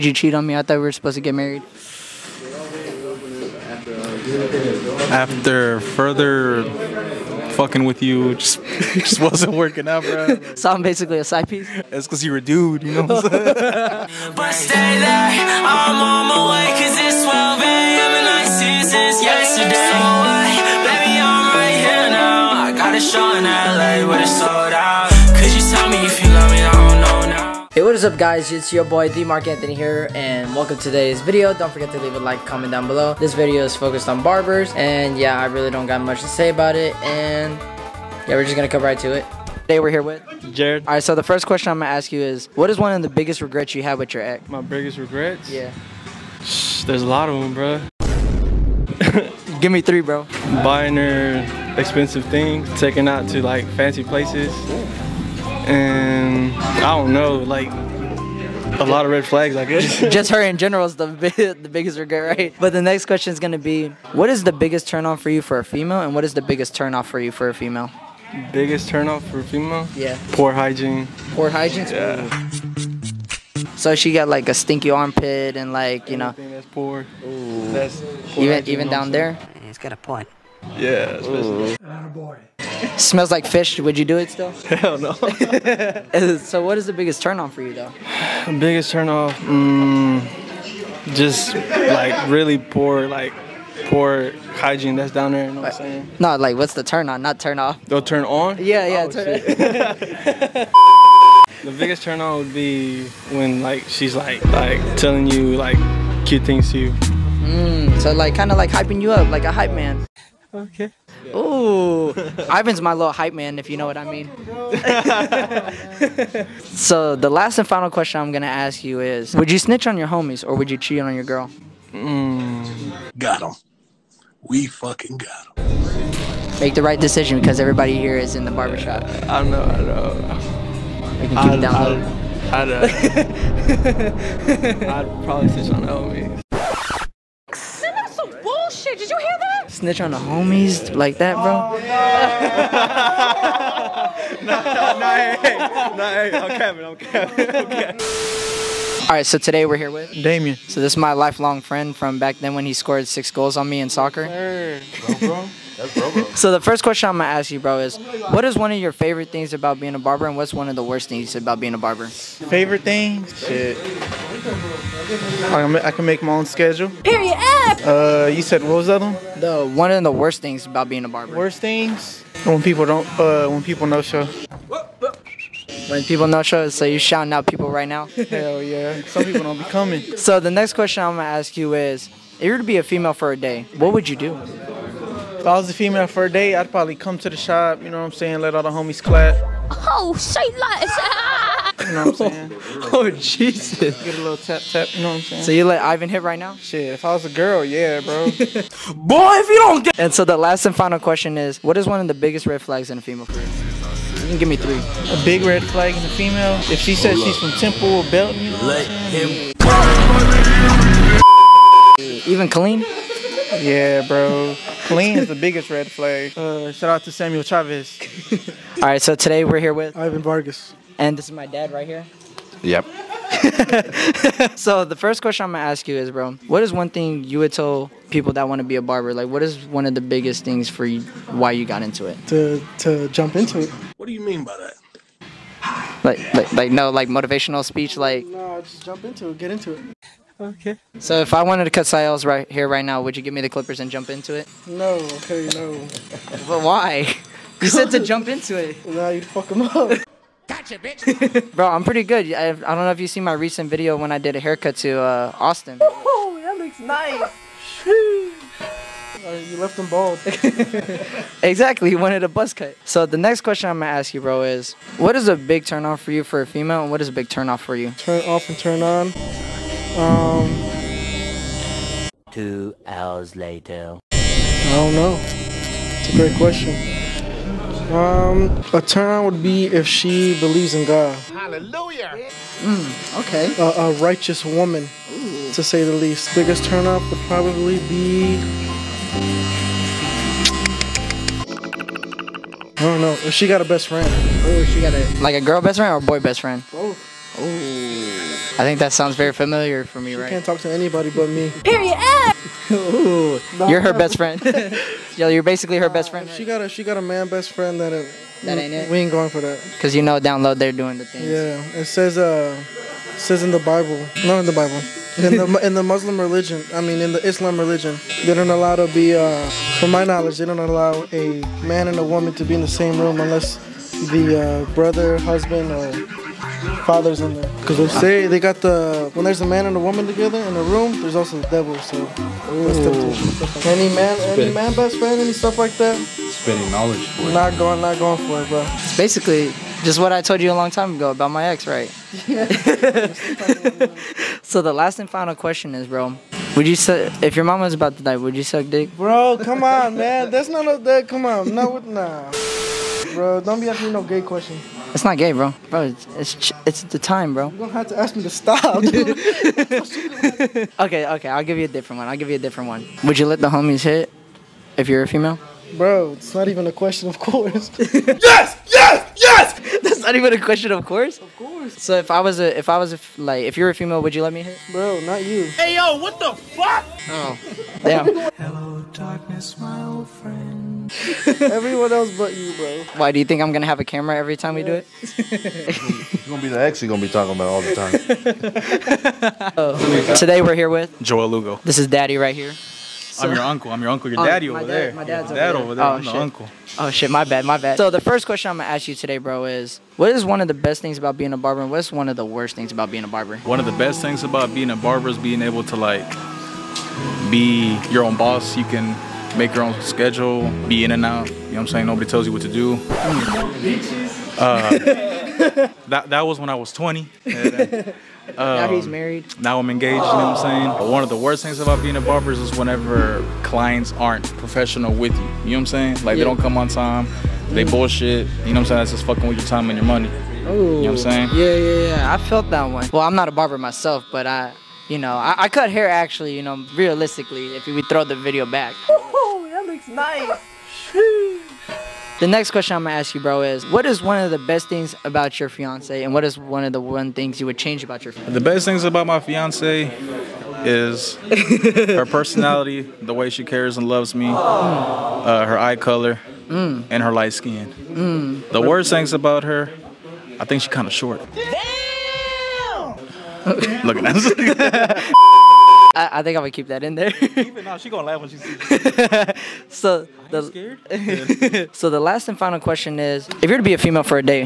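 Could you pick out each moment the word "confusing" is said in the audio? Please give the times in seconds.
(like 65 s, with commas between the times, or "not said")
not said.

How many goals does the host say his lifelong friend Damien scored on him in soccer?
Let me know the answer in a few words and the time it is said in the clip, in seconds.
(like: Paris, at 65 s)
6, at 153 s.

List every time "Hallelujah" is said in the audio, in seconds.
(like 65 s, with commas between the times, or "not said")
281 s.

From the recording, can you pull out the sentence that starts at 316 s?
I mean, in the Islam religion, they don't allow to be.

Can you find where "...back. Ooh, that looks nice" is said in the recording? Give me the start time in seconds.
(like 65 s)
438 s.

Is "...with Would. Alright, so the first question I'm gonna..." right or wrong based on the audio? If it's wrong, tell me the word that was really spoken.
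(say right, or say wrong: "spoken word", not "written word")
wrong: "Jared", not "Would".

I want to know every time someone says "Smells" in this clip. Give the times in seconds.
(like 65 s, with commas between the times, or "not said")
82 s.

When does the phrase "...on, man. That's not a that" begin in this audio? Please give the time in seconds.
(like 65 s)
349 s.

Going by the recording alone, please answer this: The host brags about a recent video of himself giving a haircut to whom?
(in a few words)
Austin.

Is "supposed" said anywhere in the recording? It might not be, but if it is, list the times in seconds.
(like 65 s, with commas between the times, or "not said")
0 s.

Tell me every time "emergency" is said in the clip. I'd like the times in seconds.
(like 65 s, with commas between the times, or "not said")
not said.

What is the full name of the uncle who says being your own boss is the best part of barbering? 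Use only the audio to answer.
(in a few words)
Joel Lugo.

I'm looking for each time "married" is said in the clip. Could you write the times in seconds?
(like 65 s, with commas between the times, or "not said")
1 s, 418 s.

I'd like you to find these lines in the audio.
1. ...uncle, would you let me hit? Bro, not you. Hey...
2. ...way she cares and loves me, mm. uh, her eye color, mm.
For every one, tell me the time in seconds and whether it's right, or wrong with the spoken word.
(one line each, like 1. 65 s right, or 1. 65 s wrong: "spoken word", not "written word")
1. 373 s wrong: "female", not "uncle"
2. 453 s right.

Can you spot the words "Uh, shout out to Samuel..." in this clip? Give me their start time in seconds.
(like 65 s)
216 s.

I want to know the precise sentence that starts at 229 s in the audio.
Like, what is one of the biggest things for you why you got into it?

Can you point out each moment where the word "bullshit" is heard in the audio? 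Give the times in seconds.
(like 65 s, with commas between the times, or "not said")
138 s, 427 s.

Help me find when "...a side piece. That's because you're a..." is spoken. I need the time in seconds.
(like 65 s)
11 s.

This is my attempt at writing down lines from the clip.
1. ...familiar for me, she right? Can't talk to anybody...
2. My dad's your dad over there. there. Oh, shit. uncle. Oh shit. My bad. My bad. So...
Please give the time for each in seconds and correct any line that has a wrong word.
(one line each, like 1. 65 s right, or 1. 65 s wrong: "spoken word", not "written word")
1. 299 s right
2. 394 s right.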